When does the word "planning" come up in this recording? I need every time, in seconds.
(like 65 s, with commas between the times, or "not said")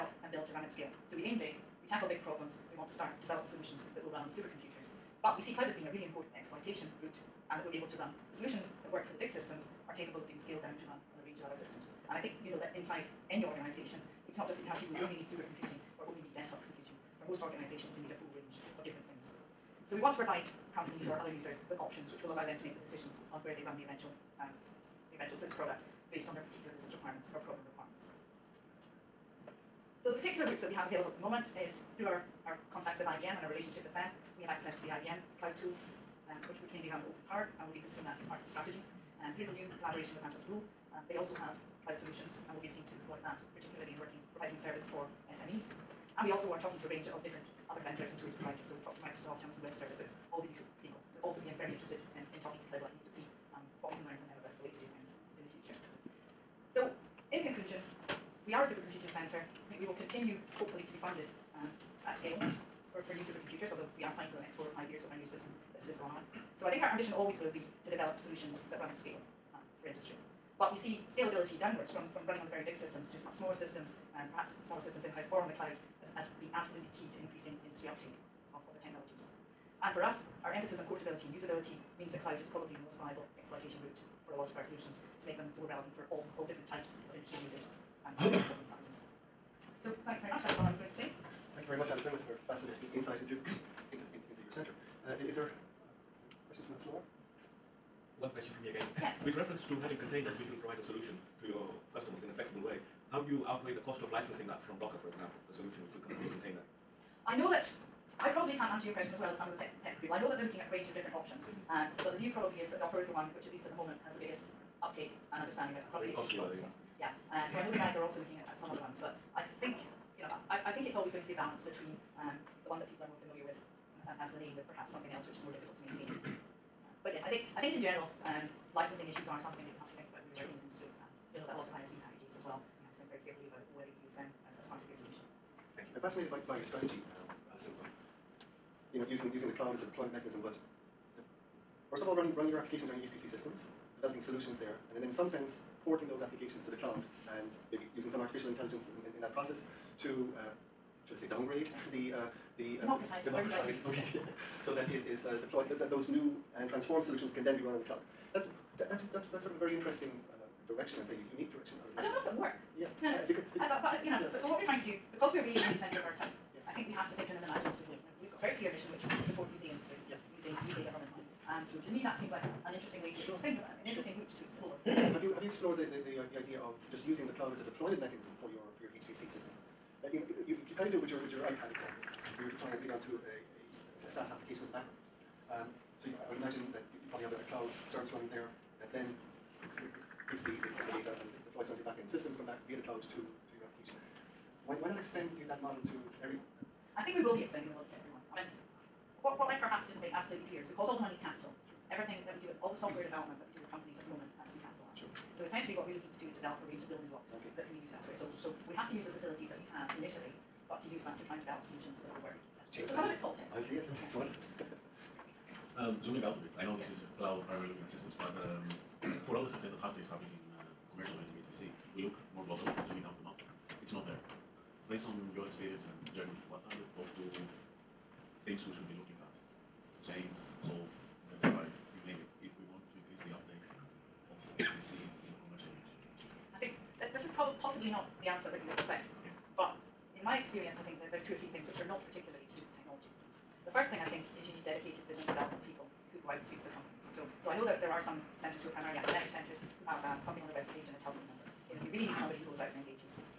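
64 s.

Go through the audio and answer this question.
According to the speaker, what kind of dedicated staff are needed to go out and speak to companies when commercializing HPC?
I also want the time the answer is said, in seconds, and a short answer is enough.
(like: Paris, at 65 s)
business development people, at 245 s.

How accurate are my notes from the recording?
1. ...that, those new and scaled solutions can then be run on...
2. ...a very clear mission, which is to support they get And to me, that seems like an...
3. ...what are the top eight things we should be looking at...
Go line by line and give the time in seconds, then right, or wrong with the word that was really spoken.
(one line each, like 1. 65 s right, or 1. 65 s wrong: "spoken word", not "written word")
1. 155 s wrong: "transformed", not "scaled"
2. 168 s right
3. 226 s wrong: "two", not "eight".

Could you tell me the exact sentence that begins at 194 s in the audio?
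Why, why not extend that model to, to everyone?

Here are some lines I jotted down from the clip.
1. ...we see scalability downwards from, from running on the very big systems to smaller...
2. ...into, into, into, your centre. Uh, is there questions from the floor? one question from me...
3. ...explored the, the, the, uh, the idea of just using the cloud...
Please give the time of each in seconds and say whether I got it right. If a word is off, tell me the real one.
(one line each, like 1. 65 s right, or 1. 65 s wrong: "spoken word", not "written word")
1. 70 s right
2. 93 s right
3. 175 s right.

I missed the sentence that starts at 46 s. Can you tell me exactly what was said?
And we also are talking to a range of different other vendors and tools providers.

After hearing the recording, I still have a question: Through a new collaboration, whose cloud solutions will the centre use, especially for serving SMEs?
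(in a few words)
Atos Bull.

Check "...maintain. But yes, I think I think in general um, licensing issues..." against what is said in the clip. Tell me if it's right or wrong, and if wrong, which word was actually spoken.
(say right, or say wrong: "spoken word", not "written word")
right.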